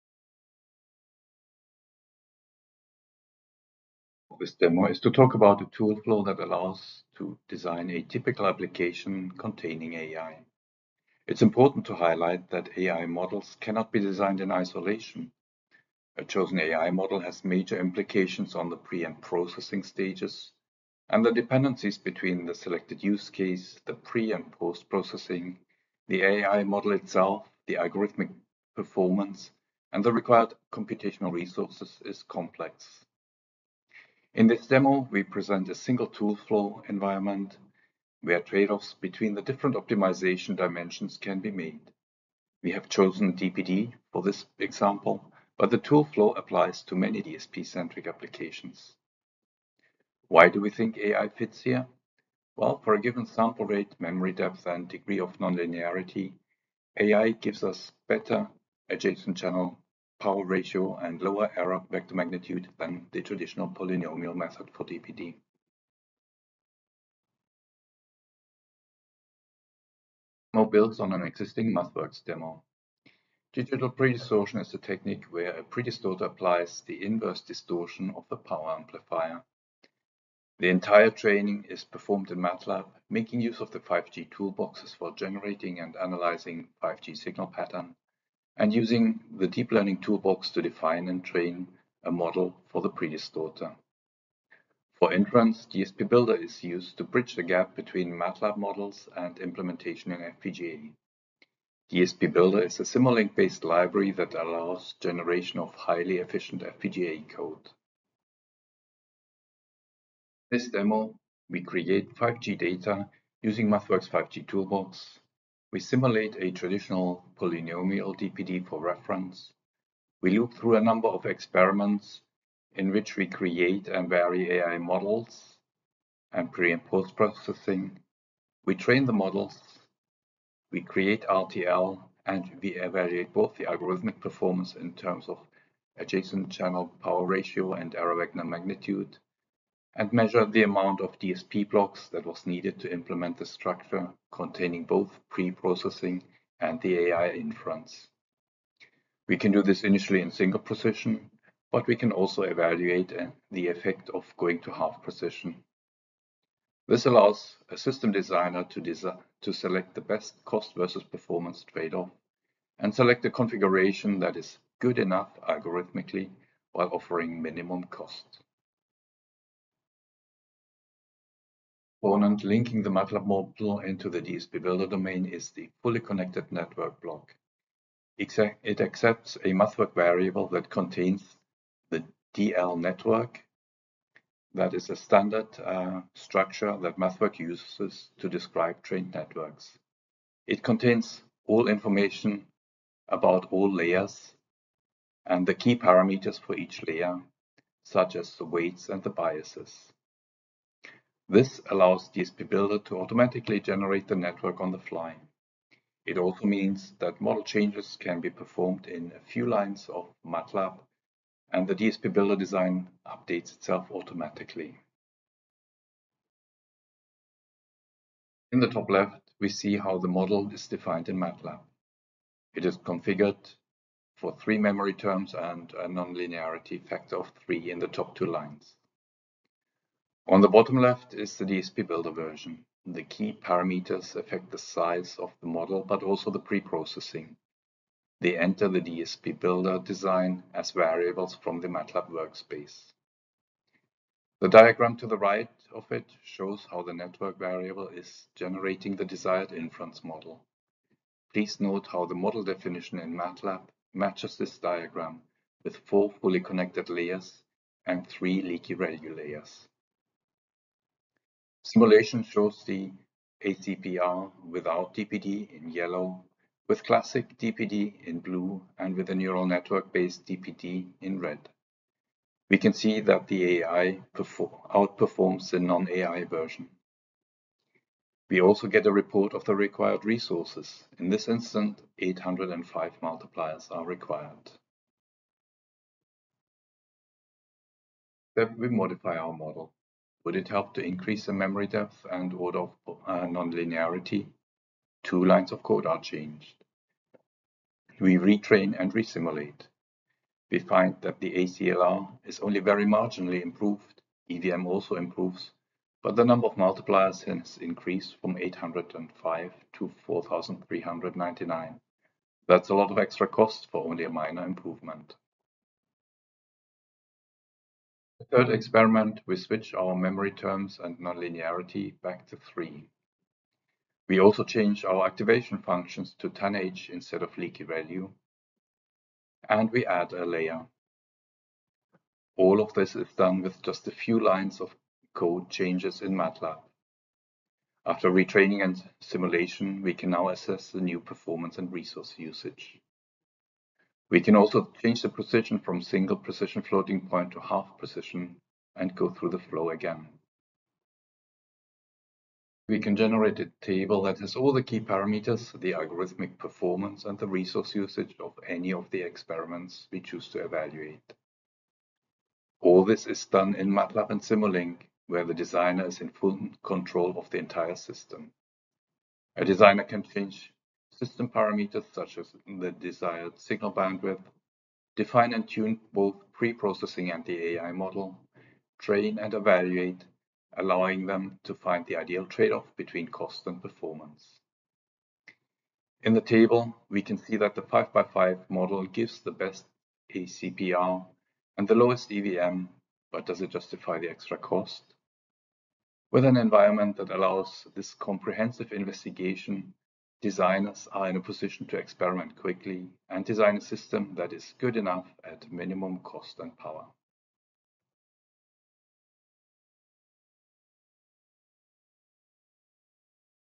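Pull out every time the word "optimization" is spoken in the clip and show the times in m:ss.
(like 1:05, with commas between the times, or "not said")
0:39.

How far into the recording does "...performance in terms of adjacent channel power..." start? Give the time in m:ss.
2:14.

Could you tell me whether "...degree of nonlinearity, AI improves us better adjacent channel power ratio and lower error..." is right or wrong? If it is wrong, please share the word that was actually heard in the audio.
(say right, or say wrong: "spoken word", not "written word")
wrong: "gives", not "improves".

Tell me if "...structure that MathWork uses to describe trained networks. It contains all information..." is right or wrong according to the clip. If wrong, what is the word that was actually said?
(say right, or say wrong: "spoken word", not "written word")
right.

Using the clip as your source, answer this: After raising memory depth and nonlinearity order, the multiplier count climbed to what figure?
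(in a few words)
4,399.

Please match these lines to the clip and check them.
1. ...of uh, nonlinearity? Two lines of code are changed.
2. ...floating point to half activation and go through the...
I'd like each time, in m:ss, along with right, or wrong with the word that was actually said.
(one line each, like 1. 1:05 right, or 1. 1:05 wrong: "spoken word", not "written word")
1. 4:52 right
2. 5:46 wrong: "precision", not "activation".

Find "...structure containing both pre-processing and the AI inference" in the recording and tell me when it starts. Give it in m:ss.
2:23.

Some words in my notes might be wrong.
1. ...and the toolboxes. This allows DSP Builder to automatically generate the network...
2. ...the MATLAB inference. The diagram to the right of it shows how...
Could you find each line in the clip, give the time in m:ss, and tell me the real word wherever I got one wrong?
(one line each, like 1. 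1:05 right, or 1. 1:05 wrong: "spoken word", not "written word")
1. 3:18 wrong: "biases", not "toolboxes"
2. 4:01 wrong: "workspace", not "inference".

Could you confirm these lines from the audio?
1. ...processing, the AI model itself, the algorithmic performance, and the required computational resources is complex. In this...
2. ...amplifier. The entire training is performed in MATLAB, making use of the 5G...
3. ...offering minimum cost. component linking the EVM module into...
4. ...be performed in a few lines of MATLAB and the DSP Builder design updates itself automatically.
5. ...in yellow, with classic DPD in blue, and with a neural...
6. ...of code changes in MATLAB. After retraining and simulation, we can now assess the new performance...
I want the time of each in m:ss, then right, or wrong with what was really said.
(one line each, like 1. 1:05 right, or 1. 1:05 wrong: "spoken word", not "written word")
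1. 0:24 right
2. 1:18 right
3. 2:46 wrong: "MATLAB", not "EVM"
4. 3:28 right
5. 4:25 right
6. 5:34 right.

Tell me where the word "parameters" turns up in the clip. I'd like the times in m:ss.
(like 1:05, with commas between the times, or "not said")
3:15, 3:53, 5:54, 6:11.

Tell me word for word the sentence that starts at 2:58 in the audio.
It accepts a MathWork variable that contains the DL network.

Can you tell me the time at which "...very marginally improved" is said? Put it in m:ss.
5:02.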